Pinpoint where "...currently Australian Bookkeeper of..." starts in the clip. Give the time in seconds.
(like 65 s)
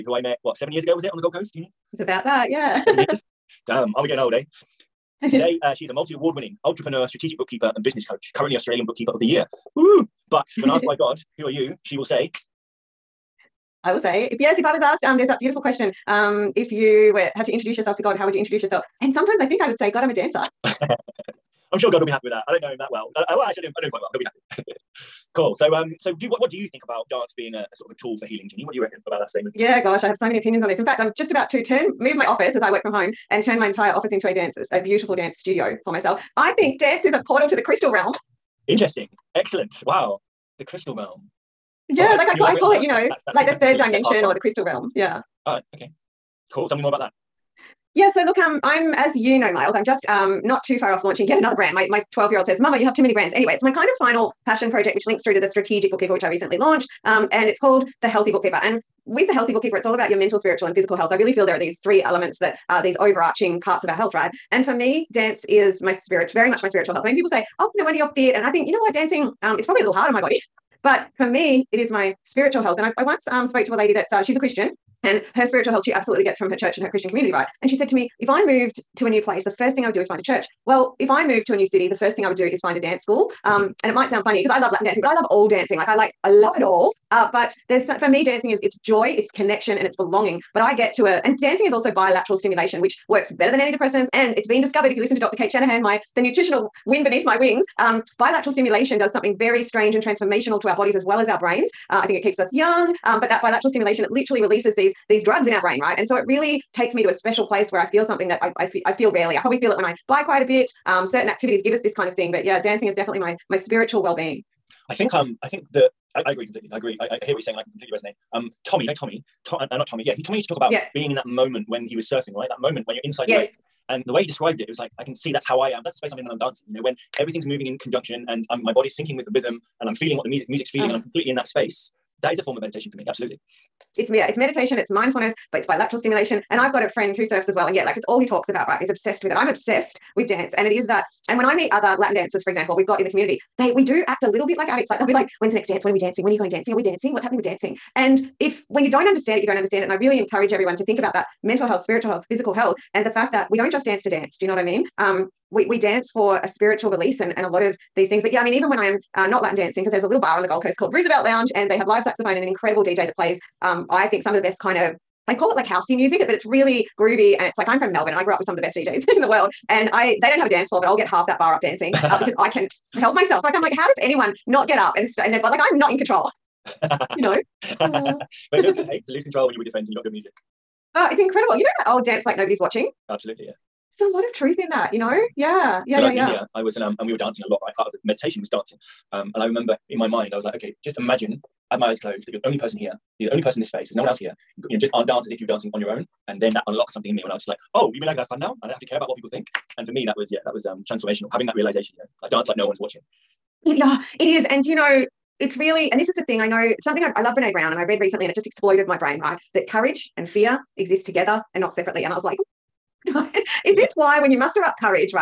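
8 s.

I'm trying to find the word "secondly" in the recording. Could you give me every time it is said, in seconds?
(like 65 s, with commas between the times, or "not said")
not said.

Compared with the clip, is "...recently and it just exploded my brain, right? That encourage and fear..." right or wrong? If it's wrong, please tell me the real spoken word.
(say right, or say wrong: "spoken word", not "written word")
wrong: "courage", not "encourage".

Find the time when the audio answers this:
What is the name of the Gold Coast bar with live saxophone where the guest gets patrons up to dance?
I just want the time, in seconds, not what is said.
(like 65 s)
160 s.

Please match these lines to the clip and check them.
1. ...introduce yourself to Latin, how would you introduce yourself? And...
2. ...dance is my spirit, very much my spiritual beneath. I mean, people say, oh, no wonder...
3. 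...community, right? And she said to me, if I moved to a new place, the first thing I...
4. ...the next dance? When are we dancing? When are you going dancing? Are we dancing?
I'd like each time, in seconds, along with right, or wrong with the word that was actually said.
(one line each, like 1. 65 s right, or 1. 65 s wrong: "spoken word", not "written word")
1. 17 s wrong: "God", not "Latin"
2. 65 s wrong: "health", not "beneath"
3. 77 s right
4. 145 s right.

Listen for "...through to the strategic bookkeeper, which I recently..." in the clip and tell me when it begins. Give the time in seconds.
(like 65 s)
55 s.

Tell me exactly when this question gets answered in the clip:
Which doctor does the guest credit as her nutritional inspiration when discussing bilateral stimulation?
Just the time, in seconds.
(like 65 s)
95 s.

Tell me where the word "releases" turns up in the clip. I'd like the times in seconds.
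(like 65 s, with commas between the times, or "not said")
104 s, 156 s.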